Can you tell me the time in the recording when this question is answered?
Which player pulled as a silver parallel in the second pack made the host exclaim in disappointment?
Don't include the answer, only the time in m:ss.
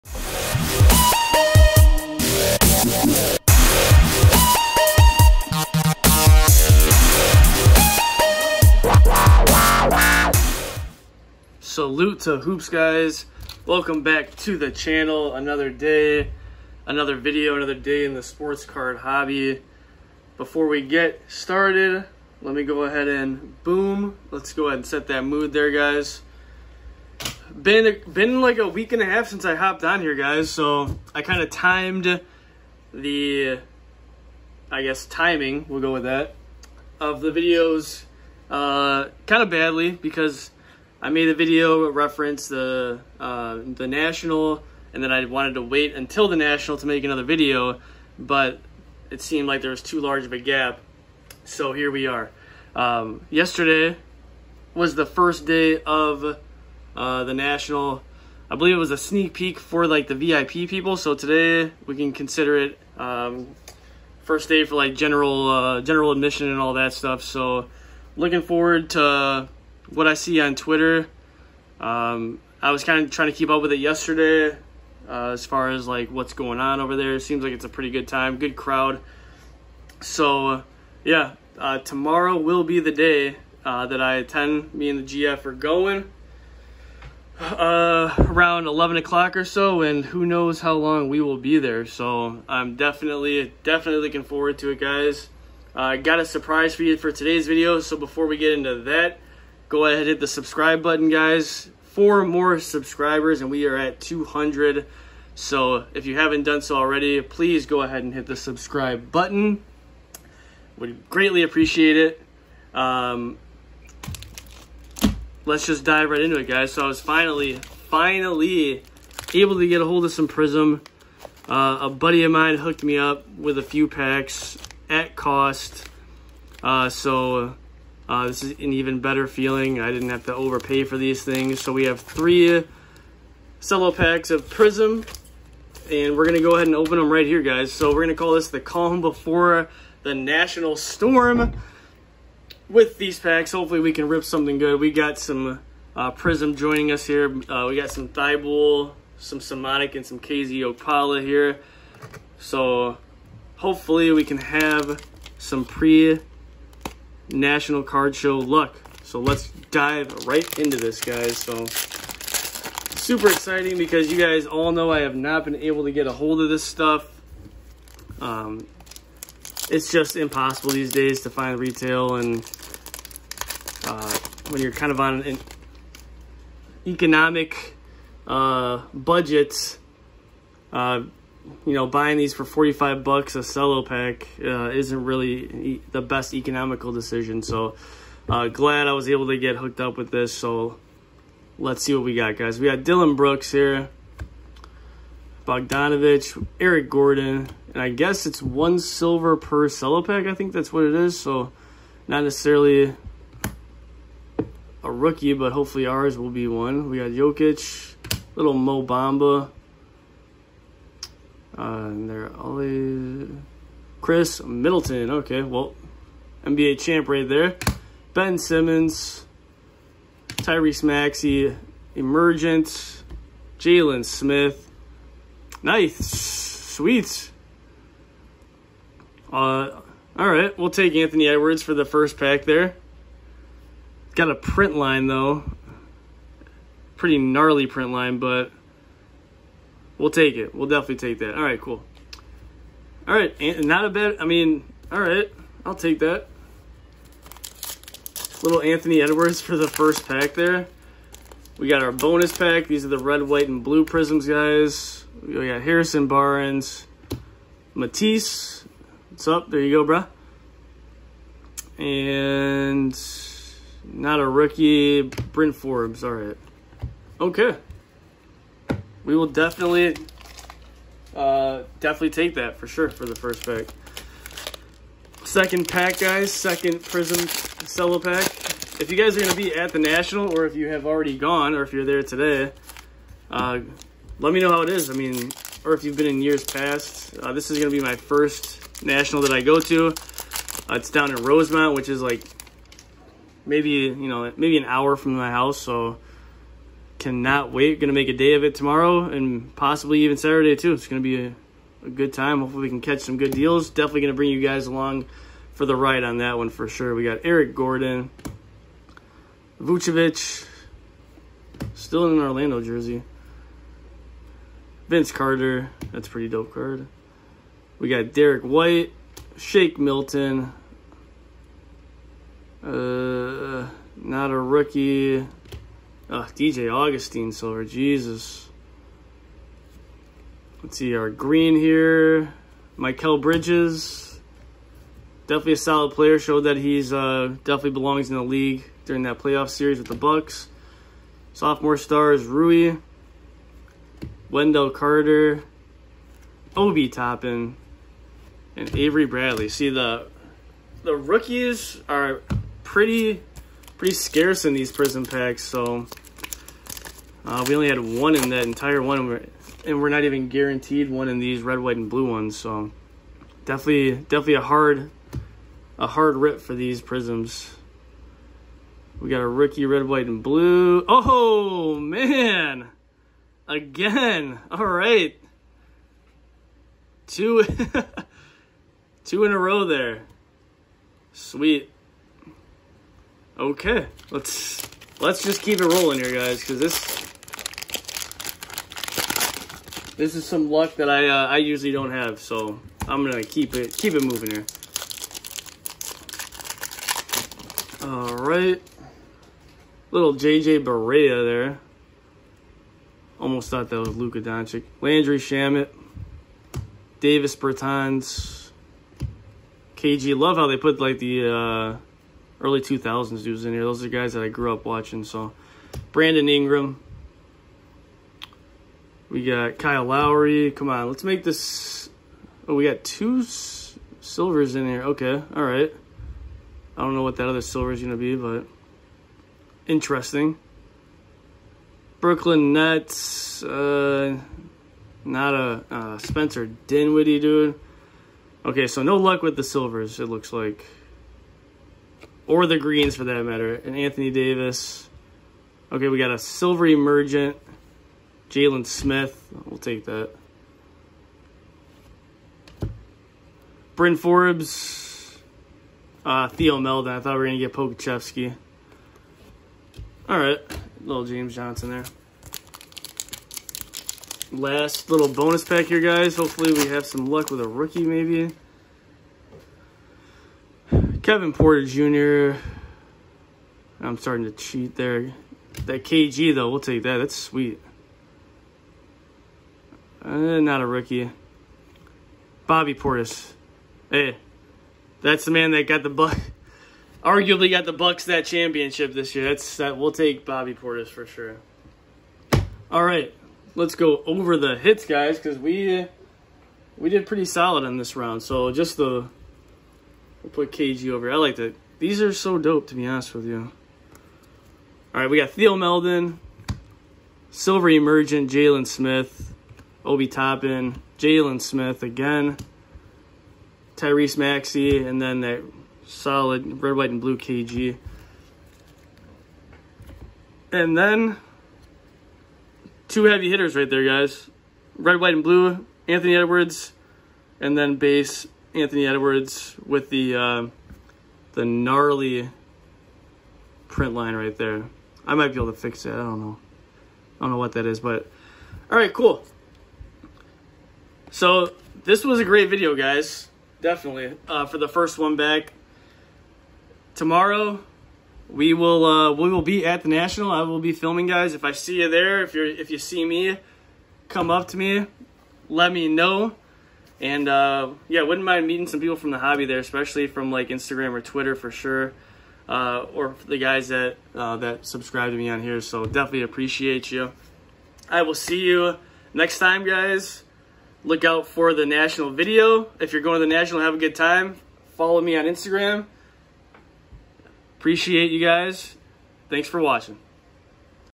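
5:26.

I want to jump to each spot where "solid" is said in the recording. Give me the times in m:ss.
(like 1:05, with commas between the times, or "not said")
5:35, 8:17, 8:35.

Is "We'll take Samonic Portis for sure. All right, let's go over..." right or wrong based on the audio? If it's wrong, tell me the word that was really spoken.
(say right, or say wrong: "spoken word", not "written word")
wrong: "Bobby", not "Samonic".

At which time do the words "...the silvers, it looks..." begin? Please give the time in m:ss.
7:19.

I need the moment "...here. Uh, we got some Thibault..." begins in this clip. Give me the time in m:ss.
2:27.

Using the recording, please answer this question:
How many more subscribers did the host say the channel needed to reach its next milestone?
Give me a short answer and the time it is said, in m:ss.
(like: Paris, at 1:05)
4, at 1:41.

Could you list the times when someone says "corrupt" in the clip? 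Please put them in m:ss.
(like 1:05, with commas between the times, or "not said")
not said.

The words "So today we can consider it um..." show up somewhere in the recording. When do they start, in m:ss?
1:00.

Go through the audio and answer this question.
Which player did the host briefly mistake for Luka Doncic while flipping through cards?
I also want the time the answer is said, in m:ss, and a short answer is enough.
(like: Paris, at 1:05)
JJ Barea, at 6:40.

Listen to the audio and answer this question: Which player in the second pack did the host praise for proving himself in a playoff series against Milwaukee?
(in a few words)
Mikal Bridges.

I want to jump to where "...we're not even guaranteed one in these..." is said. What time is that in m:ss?
5:59.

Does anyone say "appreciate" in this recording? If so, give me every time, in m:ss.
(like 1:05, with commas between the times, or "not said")
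1:51, 9:26, 9:37.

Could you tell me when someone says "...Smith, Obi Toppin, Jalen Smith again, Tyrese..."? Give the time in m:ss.
8:28.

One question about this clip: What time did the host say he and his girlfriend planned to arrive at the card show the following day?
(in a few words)
11 o'clock.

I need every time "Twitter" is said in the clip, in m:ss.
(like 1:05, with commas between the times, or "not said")
1:10, 9:21.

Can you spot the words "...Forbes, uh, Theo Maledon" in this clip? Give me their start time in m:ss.
7:33.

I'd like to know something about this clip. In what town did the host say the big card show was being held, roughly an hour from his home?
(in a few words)
Rosemont.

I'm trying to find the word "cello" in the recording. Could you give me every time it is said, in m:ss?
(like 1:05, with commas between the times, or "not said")
2:13, 3:03, 3:19, 4:37.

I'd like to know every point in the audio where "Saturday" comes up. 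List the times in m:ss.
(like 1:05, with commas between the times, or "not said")
5:00.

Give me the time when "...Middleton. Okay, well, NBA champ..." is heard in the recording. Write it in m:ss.
3:34.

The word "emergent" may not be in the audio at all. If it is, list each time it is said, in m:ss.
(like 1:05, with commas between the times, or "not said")
3:41, 7:26, 8:27.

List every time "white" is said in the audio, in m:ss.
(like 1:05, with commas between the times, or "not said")
4:13, 5:18, 6:01, 6:09, 8:36, 8:44.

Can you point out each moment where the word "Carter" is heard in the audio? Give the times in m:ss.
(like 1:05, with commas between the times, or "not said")
5:15, 5:44.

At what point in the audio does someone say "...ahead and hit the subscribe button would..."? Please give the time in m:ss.
1:47.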